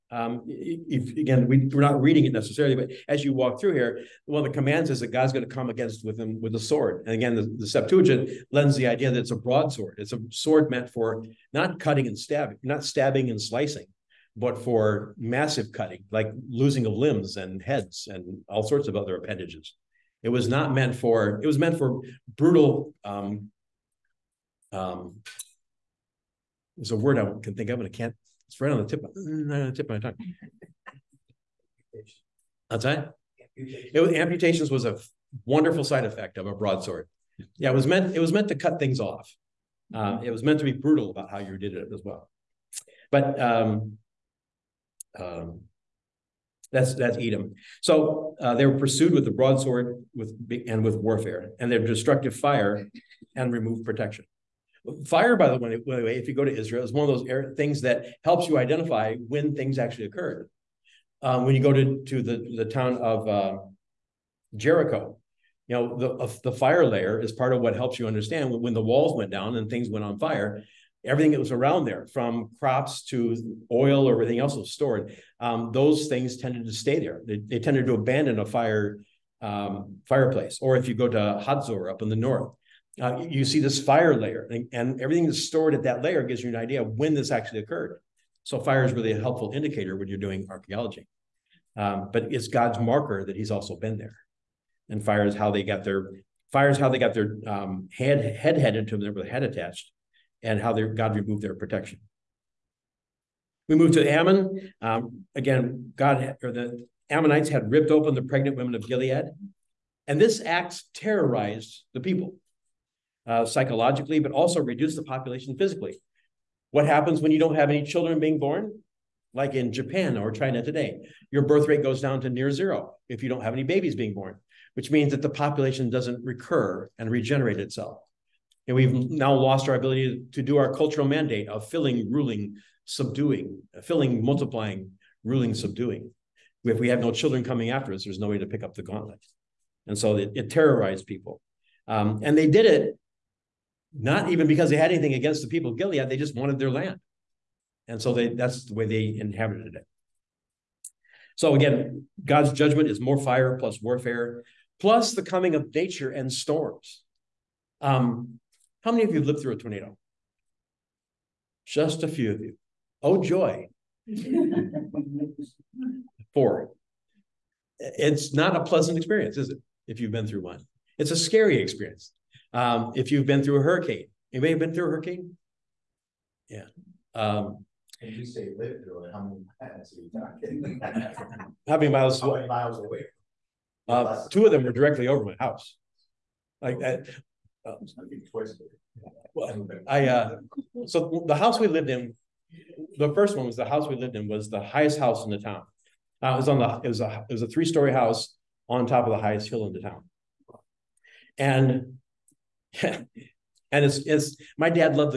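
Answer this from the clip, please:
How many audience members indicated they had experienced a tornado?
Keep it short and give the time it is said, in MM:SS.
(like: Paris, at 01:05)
4, at 02:46.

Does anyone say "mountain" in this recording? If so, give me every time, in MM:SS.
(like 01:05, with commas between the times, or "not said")
not said.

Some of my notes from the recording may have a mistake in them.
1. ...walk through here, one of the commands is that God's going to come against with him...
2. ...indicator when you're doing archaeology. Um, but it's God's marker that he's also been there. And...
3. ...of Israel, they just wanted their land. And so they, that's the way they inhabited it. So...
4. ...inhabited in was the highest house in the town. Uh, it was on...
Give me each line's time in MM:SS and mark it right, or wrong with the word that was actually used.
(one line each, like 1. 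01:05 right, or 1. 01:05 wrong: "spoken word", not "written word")
1. 00:03 right
2. 01:29 right
3. 02:25 wrong: "Gilead", not "Israel"
4. 03:13 wrong: "lived", not "inhabited".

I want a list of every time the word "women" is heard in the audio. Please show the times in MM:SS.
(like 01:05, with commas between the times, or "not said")
01:48.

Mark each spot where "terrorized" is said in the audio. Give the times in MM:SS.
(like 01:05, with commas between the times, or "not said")
01:50, 02:20.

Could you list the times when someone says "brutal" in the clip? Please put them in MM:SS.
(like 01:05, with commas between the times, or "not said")
00:22, 00:40.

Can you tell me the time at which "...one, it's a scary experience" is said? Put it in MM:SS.
02:50.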